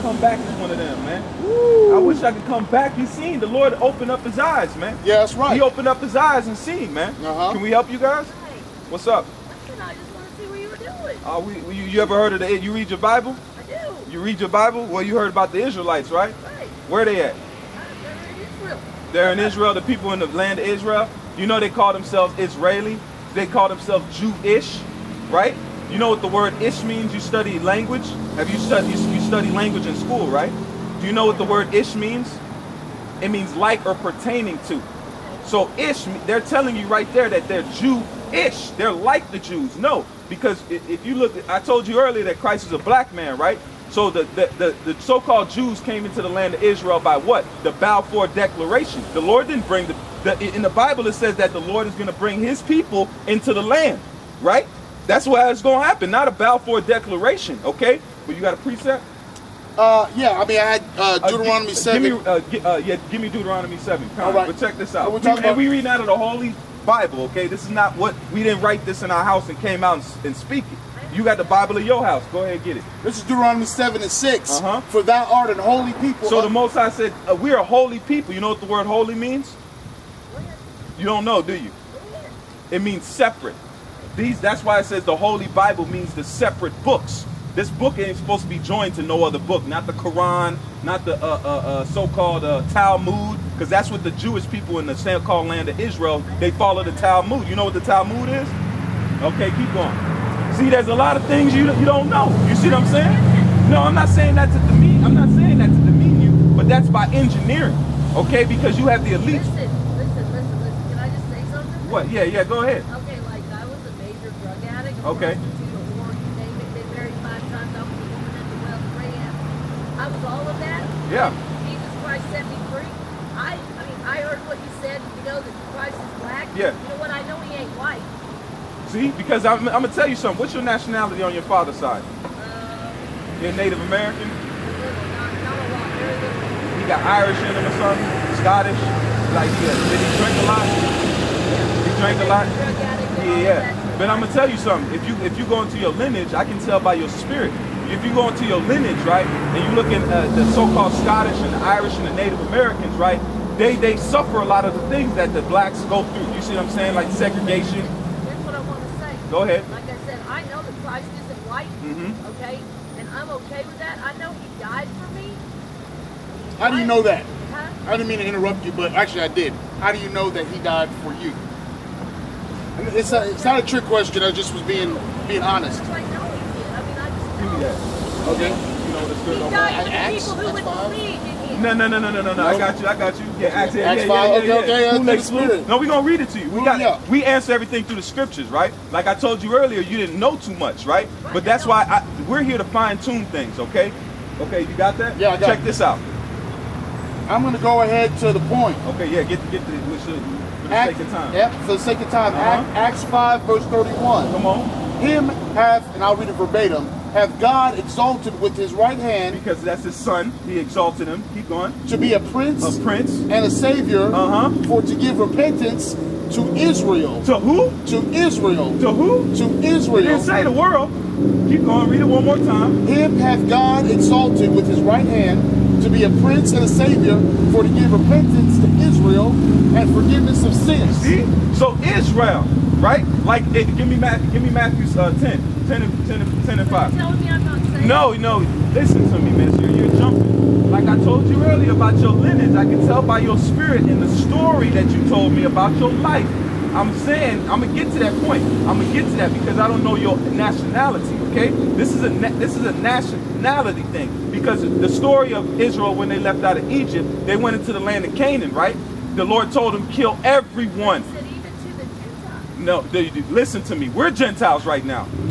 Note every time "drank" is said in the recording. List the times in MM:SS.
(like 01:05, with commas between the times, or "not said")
02:22.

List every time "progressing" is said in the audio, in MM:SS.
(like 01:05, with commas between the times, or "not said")
not said.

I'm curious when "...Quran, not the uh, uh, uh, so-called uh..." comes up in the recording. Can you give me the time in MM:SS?
01:29.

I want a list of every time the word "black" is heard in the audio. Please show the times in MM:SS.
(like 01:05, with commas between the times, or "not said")
00:42, 02:06, 02:35.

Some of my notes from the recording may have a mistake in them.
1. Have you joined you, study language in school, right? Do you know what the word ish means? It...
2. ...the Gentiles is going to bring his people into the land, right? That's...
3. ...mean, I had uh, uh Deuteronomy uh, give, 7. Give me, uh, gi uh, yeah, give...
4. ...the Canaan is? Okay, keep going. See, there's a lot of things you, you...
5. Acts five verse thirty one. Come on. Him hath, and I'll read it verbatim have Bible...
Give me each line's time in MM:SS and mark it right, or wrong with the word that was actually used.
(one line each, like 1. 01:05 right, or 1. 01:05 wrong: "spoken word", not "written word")
1. 00:28 wrong: "studied", not "joined"
2. 00:51 wrong: "Lord", not "Gentiles"
3. 01:00 right
4. 01:37 wrong: "Talmud", not "Canaan"
5. 03:22 wrong: "God", not "Bible".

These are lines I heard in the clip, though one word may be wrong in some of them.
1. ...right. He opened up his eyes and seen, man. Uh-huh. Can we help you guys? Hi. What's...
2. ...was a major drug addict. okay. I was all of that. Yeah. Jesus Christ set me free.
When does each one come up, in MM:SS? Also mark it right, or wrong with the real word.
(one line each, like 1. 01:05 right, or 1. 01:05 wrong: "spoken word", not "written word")
1. 00:05 right
2. 01:53 right.